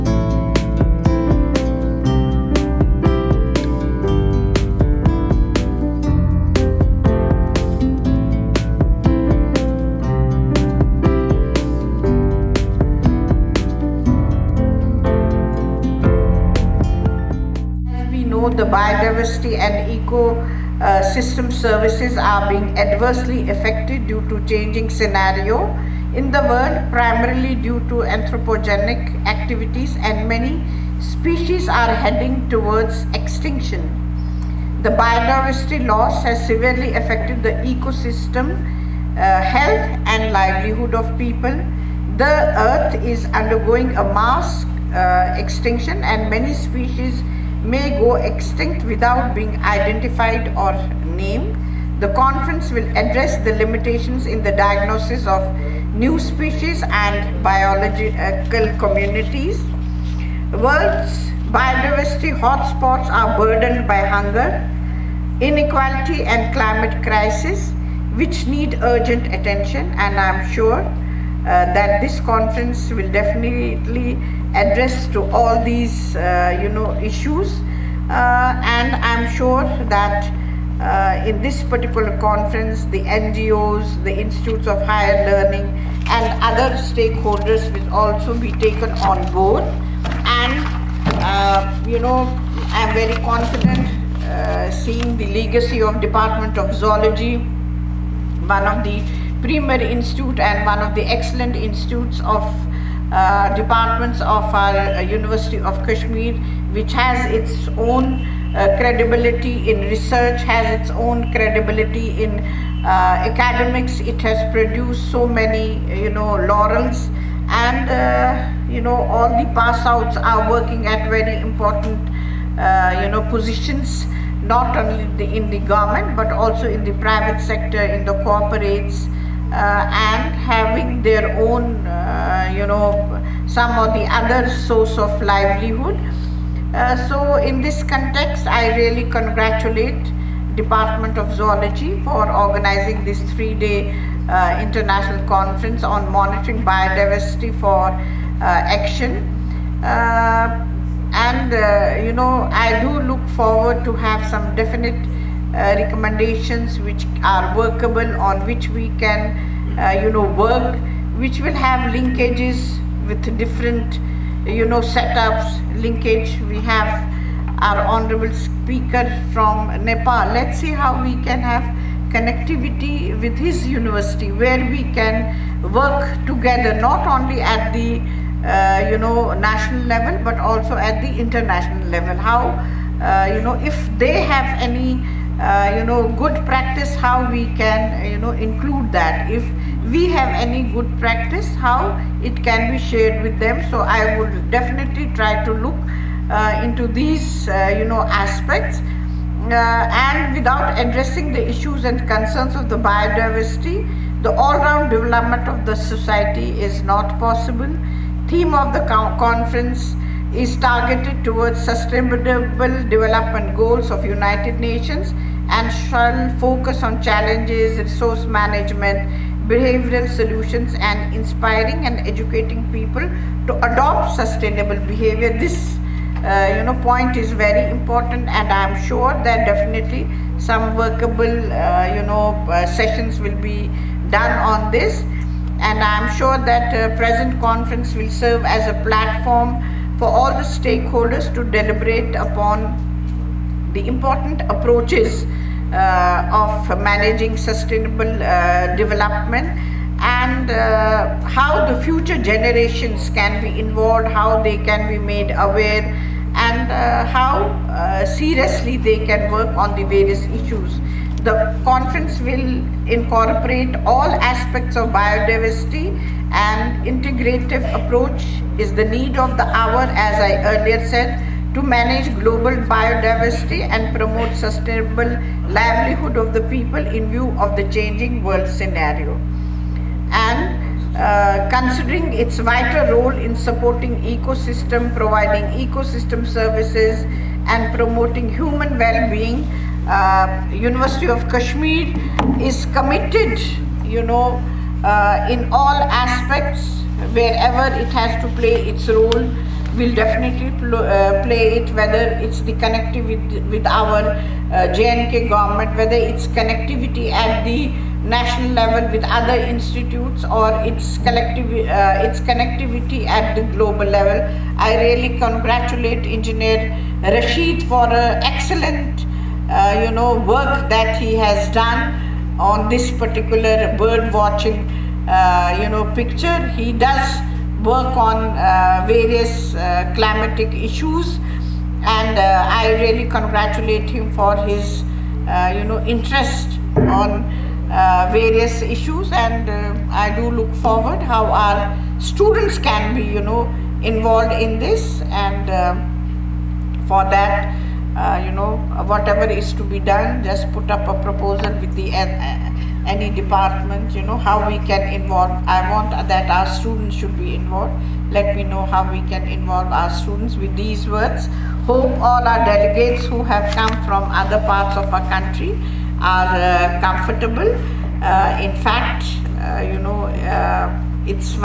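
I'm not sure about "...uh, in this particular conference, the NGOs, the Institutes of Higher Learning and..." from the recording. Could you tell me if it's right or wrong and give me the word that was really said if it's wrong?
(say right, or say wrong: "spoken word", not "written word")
right.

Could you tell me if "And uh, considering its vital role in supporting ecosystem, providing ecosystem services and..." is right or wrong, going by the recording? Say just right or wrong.
right.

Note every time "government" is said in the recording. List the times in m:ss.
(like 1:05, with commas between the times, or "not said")
2:05, 5:05.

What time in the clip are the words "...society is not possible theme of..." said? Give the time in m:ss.
3:25.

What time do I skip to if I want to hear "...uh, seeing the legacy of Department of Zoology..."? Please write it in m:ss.
1:34.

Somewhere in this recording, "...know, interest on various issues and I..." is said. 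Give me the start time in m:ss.
5:35.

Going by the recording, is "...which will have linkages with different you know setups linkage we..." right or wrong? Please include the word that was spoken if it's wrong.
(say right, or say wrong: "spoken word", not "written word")
right.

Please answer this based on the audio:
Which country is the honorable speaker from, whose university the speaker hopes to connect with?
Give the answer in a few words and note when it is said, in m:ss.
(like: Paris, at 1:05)
Nepal, at 2:49.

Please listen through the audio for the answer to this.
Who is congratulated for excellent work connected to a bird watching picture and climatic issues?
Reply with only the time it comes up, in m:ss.
5:16.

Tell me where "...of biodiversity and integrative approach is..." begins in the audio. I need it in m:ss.
4:24.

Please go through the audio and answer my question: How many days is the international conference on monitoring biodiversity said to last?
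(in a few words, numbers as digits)
3.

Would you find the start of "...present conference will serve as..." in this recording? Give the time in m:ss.
3:56.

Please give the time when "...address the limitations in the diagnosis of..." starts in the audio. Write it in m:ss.
0:52.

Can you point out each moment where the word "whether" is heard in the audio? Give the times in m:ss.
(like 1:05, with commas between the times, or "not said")
5:01, 5:05.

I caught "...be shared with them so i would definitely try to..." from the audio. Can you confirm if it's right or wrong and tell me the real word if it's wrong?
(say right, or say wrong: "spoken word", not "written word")
right.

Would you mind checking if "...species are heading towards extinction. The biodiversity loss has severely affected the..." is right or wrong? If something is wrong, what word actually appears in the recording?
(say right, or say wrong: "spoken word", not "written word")
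right.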